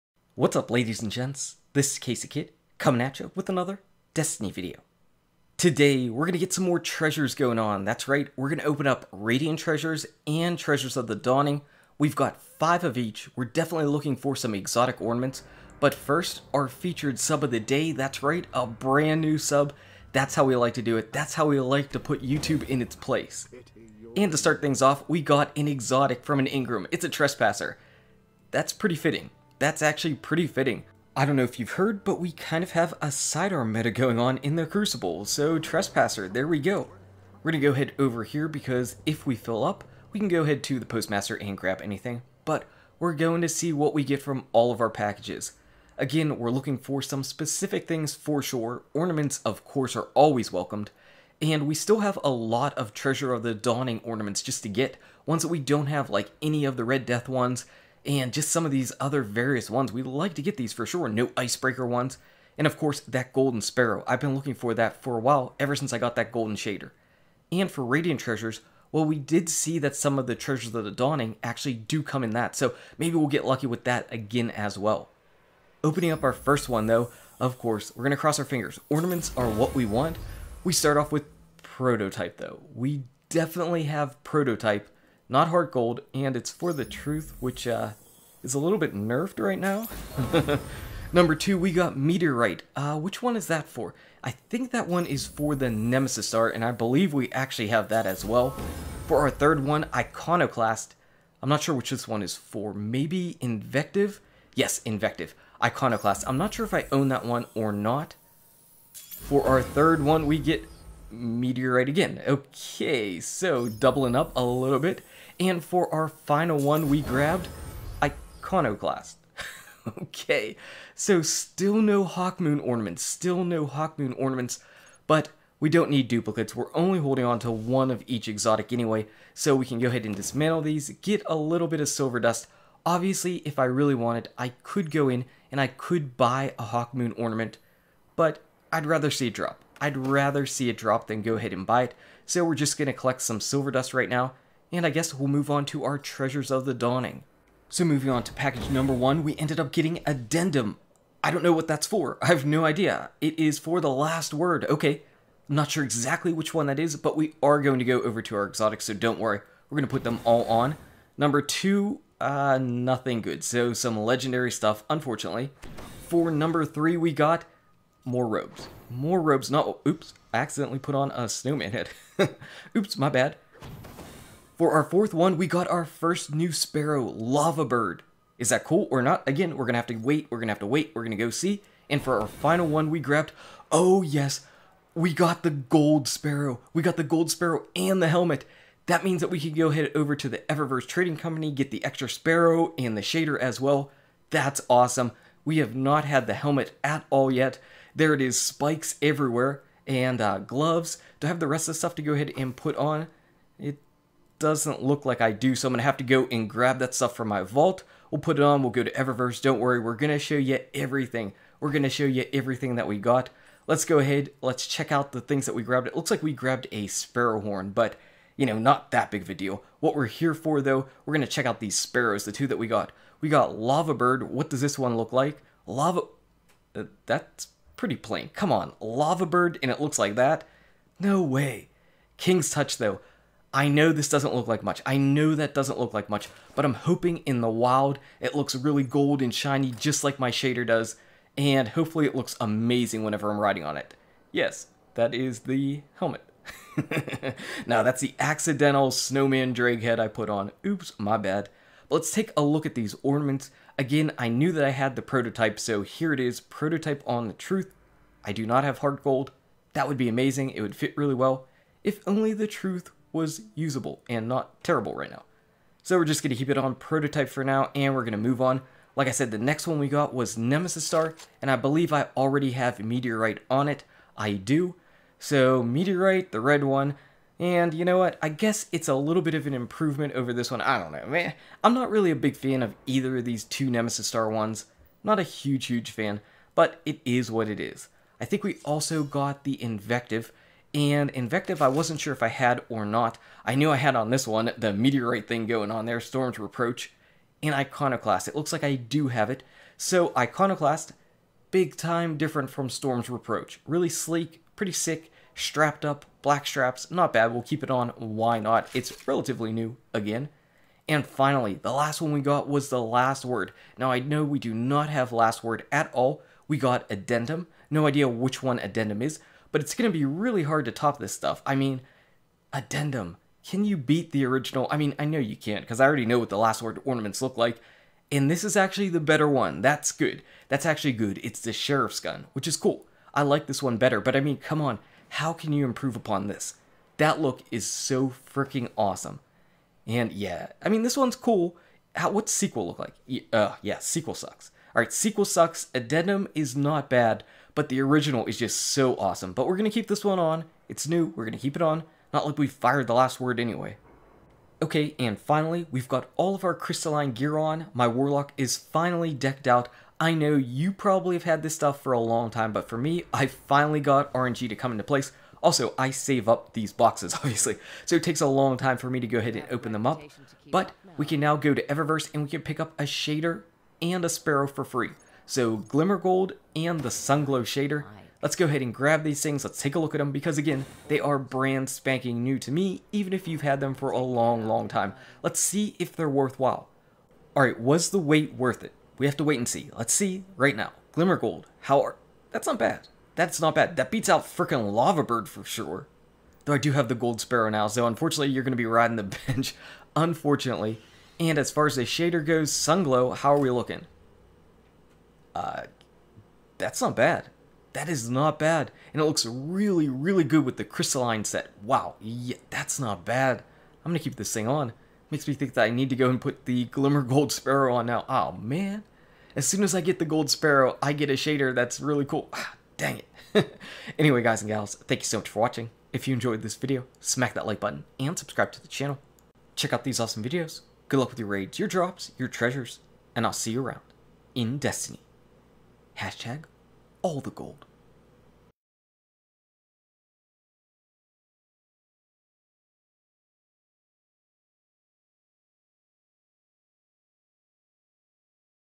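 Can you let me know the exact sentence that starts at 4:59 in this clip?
So Iconoclast, big time different from Storm's Reproach.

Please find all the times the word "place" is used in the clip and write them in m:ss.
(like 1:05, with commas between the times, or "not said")
0:22, 6:04.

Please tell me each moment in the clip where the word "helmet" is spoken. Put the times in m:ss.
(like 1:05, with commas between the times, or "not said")
3:08, 3:16, 4:05.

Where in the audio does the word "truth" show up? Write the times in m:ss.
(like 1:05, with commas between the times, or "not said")
1:26, 4:17, 4:22.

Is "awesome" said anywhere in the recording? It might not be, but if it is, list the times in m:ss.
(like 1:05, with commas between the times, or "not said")
3:14, 5:38, 5:48, 7:09.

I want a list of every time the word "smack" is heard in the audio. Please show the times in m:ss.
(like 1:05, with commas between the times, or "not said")
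7:06.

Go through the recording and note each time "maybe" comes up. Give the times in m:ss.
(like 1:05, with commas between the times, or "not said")
1:12, 1:42.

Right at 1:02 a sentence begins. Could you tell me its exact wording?
And of course, that golden sparrow.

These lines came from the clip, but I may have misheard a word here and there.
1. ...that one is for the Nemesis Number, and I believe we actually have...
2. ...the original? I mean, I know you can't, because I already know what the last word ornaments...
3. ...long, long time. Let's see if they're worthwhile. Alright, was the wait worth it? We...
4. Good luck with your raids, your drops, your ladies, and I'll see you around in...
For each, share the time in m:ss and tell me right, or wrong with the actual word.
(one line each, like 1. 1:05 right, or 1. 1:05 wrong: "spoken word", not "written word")
1. 1:34 wrong: "Star", not "Number"
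2. 5:24 right
3. 6:23 right
4. 7:10 wrong: "treasures", not "ladies".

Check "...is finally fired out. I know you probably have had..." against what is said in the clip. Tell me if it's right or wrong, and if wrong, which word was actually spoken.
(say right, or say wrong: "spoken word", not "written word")
wrong: "decked", not "fired".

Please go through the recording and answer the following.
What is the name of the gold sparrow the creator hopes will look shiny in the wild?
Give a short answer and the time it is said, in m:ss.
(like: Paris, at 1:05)
King's Touch, at 3:52.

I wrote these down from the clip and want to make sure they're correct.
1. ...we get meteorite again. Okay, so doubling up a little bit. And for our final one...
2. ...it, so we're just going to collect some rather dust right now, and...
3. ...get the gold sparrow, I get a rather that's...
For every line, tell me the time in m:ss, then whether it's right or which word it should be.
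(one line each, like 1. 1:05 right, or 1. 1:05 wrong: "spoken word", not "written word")
1. 1:50 right
2. 2:21 wrong: "silver", not "rather"
3. 6:59 wrong: "shader", not "rather".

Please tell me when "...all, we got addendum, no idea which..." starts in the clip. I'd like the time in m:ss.
5:15.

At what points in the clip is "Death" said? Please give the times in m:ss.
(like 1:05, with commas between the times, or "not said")
0:57.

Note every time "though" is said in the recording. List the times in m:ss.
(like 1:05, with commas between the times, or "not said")
1:16, 1:22, 3:40, 3:52, 6:36.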